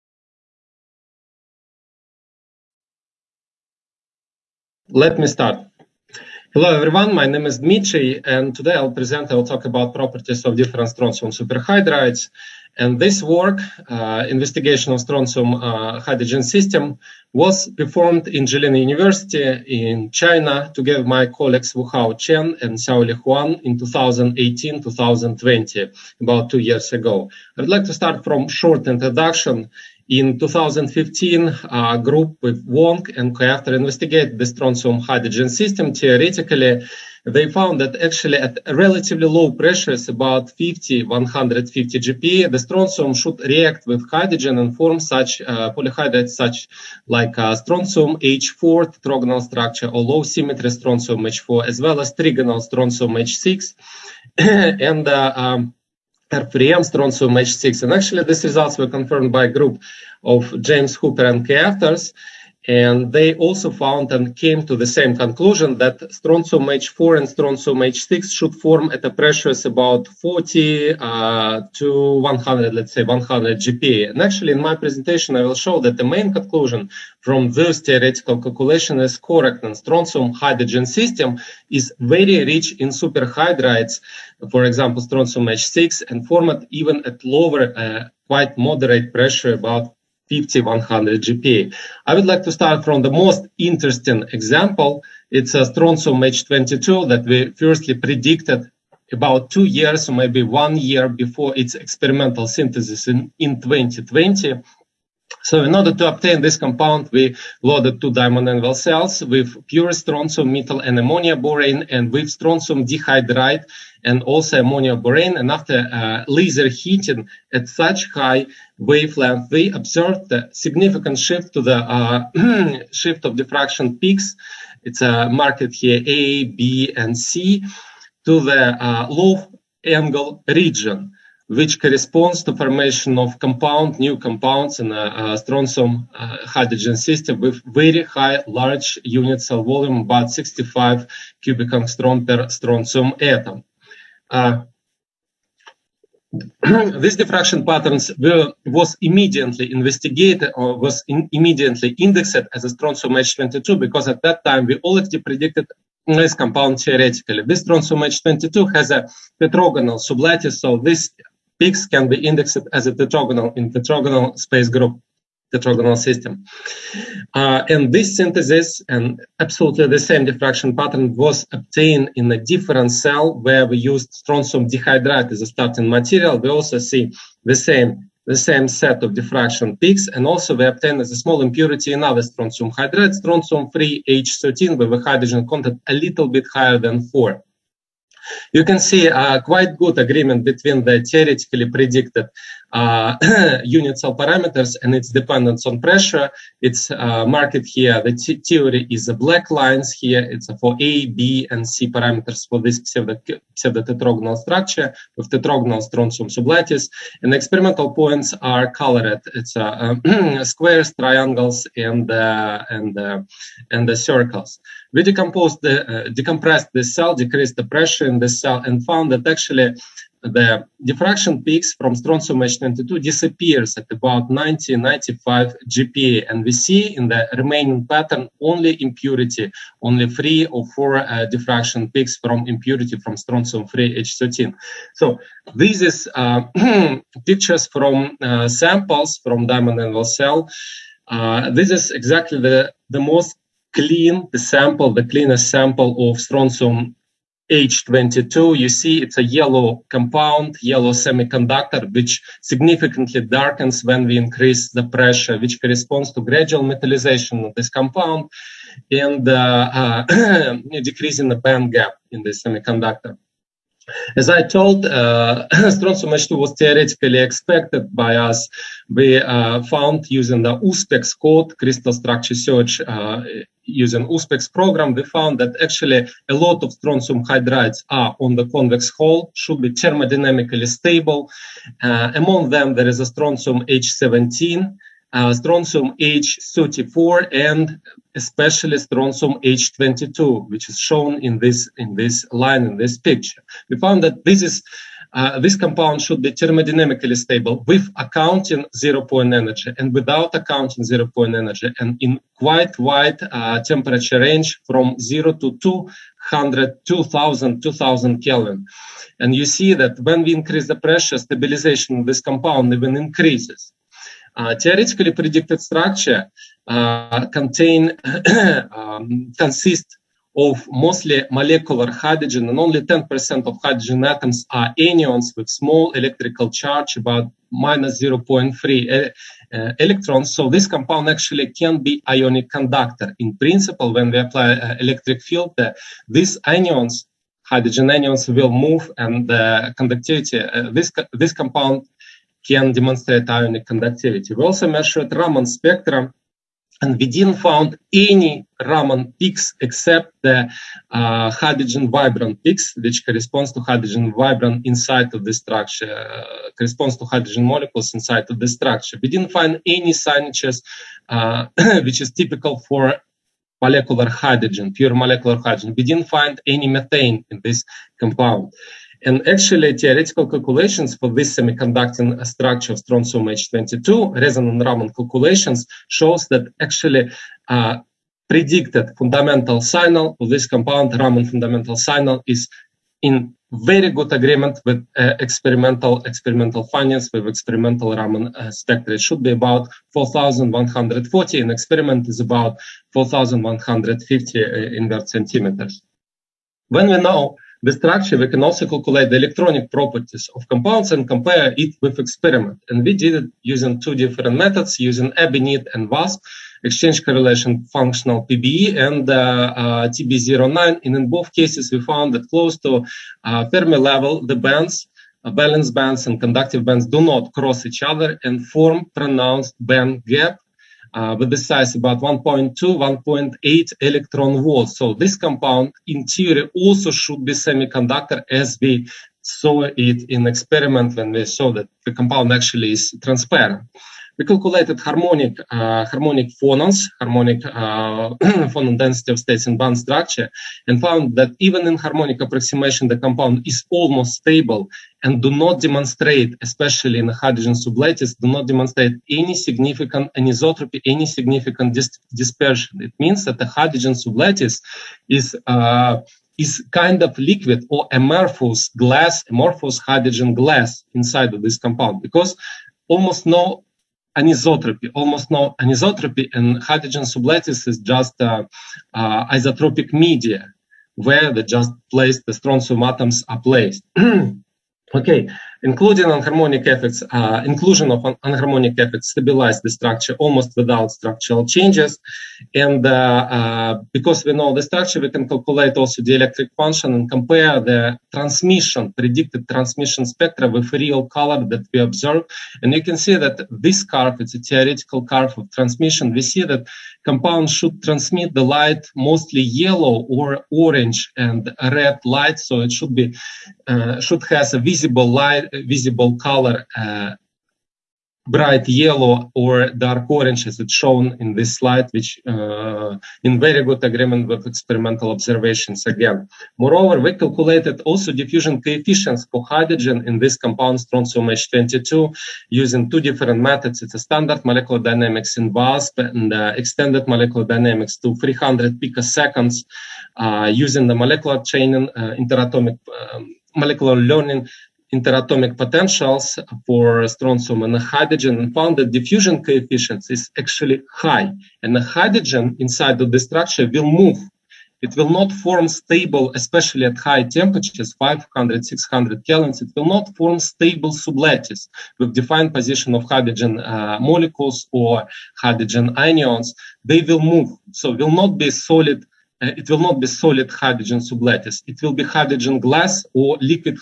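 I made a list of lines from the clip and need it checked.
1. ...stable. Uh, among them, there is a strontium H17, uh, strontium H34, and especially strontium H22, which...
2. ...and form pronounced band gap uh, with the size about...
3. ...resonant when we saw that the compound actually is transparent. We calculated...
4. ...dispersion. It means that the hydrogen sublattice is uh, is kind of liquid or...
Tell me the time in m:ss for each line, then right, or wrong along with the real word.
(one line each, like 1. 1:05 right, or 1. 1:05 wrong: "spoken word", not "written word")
1. 4:40 right
2. 6:58 right
3. 7:10 wrong: "experiment", not "resonant"
4. 7:32 right.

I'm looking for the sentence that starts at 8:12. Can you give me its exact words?
And you can see that this curve, it's a theoretical curve of transmission.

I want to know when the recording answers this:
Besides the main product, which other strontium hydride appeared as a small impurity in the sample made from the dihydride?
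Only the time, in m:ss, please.
3:03.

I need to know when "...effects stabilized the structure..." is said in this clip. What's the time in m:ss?
7:58.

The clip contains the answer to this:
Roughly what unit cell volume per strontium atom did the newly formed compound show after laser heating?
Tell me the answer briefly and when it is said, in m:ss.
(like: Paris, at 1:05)
65 cubic angstrom, at 2:20.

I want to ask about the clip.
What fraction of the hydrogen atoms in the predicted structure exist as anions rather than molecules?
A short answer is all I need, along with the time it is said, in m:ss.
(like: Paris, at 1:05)
10%, at 5:22.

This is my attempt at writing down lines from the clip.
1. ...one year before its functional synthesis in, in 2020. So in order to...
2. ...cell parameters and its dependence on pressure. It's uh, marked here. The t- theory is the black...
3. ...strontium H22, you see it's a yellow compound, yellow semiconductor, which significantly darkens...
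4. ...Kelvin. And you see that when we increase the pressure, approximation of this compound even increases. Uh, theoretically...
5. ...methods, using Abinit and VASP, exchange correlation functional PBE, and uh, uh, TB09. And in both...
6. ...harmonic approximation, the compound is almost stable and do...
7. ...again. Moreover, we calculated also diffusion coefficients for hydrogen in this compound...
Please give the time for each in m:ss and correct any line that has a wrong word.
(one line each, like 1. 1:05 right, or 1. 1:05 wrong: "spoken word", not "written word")
1. 1:40 wrong: "experimental", not "functional"
2. 3:13 right
3. 4:06 right
4. 5:08 wrong: "stabilization", not "approximation"
5. 6:44 right
6. 7:21 right
7. 8:35 right.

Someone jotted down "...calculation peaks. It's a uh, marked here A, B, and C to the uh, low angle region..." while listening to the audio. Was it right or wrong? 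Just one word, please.
wrong.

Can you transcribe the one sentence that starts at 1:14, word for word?
And actually, in my presentation, I will show that the main conclusion from this theoretical calculation is correct.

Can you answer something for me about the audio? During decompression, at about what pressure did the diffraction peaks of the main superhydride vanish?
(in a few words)
90-95 GPa.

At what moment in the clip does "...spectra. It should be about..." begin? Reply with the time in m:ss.
6:28.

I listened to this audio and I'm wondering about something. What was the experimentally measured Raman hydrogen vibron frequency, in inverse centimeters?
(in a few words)
4150.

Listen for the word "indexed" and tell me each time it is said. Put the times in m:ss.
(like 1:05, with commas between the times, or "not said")
2:31, 2:42.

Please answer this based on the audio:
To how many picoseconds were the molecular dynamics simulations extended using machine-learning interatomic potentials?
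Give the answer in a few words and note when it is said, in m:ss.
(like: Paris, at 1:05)
300 picoseconds, at 8:48.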